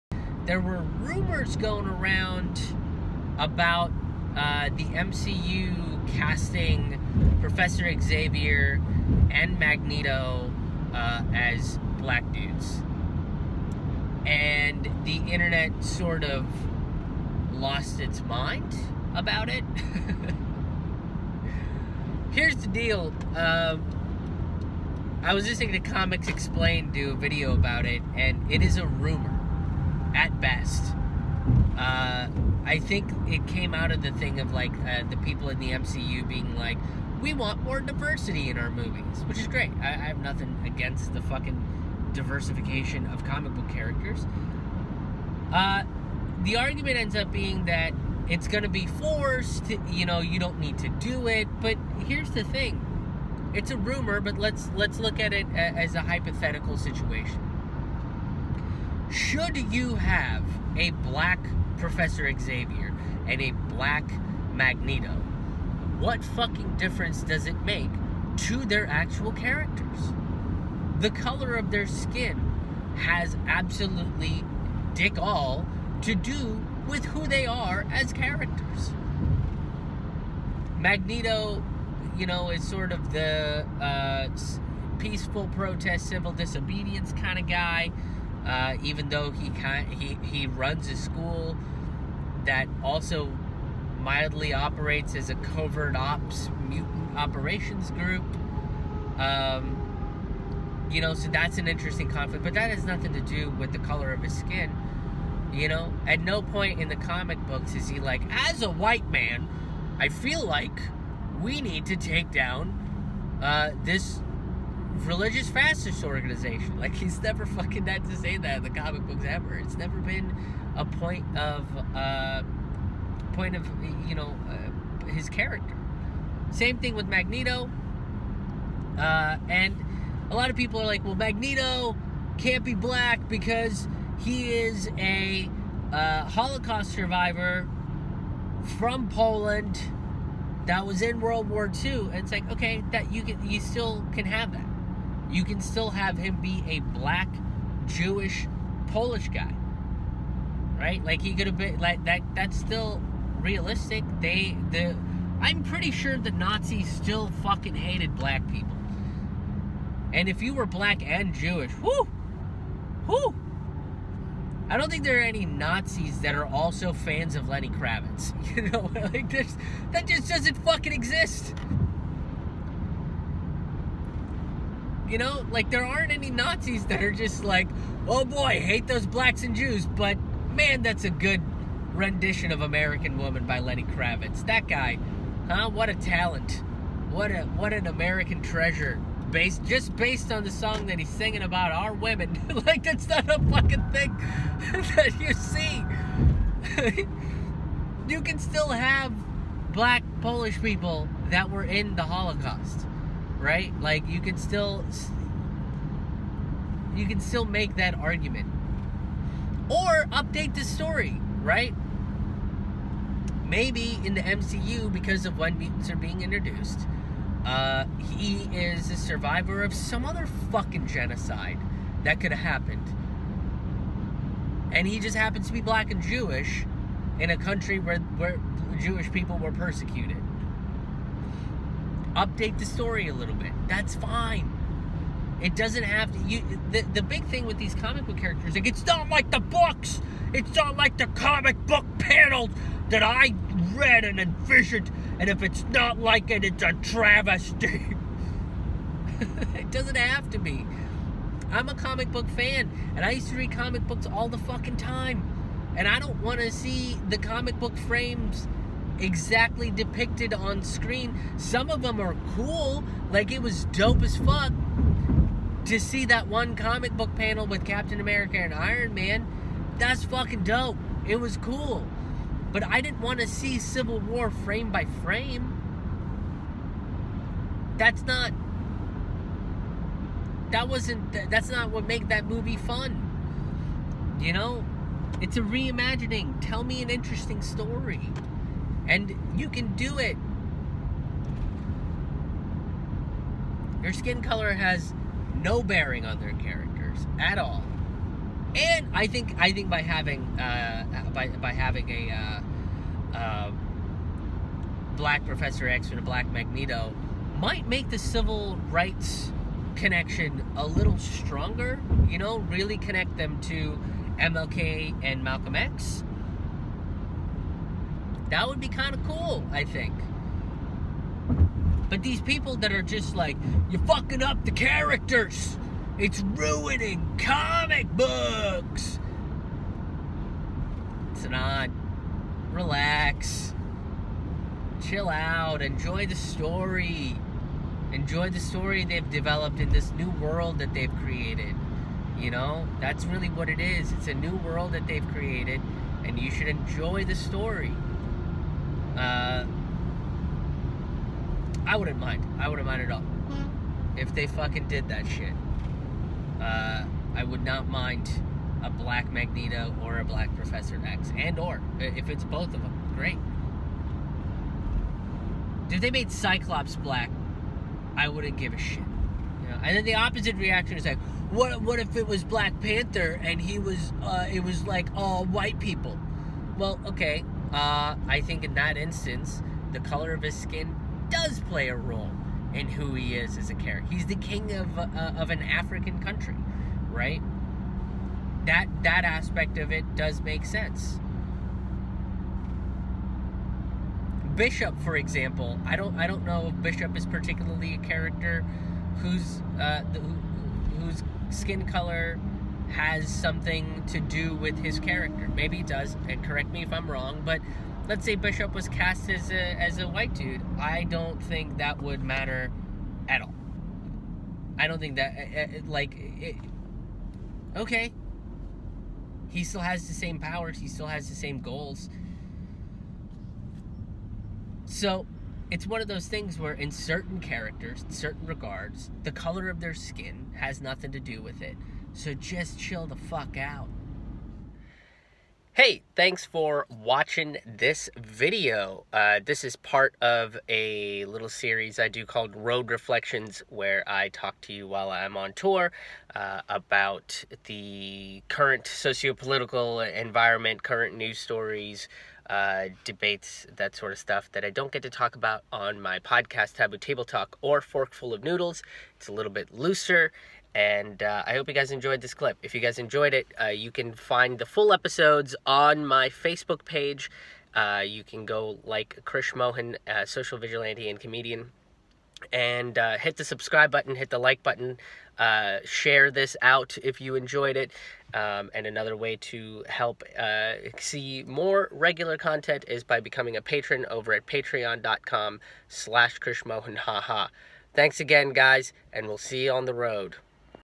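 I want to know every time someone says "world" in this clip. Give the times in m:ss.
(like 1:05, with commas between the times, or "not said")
2:21, 5:40, 5:44.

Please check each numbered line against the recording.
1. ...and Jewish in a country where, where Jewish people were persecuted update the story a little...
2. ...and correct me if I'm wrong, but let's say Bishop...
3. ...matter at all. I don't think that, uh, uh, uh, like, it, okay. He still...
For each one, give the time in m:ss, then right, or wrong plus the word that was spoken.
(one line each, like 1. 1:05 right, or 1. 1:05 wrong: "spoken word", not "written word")
1. 3:45 right
2. 6:46 right
3. 6:52 right.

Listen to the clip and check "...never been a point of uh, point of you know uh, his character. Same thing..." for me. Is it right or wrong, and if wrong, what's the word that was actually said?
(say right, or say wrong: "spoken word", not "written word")
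right.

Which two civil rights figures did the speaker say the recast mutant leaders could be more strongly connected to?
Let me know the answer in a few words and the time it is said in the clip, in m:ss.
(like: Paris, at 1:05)
MLK and Malcolm X, at 5:14.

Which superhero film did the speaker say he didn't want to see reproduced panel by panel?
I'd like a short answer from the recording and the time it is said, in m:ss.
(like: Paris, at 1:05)
Civil War, at 4:33.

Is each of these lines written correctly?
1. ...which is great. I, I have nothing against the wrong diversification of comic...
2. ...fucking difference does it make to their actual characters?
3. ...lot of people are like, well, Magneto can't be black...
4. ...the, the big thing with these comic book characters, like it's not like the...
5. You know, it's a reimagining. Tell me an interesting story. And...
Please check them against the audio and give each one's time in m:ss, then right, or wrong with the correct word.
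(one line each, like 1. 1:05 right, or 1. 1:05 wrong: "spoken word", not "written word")
1. 0:39 wrong: "fucking", not "wrong"
2. 1:06 right
3. 2:10 right
4. 3:56 right
5. 4:44 right.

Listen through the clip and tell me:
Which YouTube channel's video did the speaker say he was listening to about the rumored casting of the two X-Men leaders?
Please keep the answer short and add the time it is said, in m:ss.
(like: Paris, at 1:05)
Comics Explained, at 0:25.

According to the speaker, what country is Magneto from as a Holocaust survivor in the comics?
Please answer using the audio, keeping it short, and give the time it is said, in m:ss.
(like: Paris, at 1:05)
Poland, at 2:19.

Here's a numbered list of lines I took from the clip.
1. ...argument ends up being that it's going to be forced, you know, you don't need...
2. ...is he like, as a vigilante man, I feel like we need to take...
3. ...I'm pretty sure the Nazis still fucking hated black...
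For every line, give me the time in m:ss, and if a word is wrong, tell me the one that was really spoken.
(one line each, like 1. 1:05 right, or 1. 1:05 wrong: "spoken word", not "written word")
1. 0:46 right
2. 1:47 wrong: "white", not "vigilante"
3. 2:35 right.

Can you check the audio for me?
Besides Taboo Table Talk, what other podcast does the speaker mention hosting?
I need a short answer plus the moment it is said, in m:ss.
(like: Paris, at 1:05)
Forkful of Noodles, at 7:37.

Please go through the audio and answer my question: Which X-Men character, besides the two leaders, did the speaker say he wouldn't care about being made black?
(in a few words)
Cyclops.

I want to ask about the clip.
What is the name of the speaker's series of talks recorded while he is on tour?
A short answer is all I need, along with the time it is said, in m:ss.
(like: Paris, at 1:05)
Road Reflections, at 7:22.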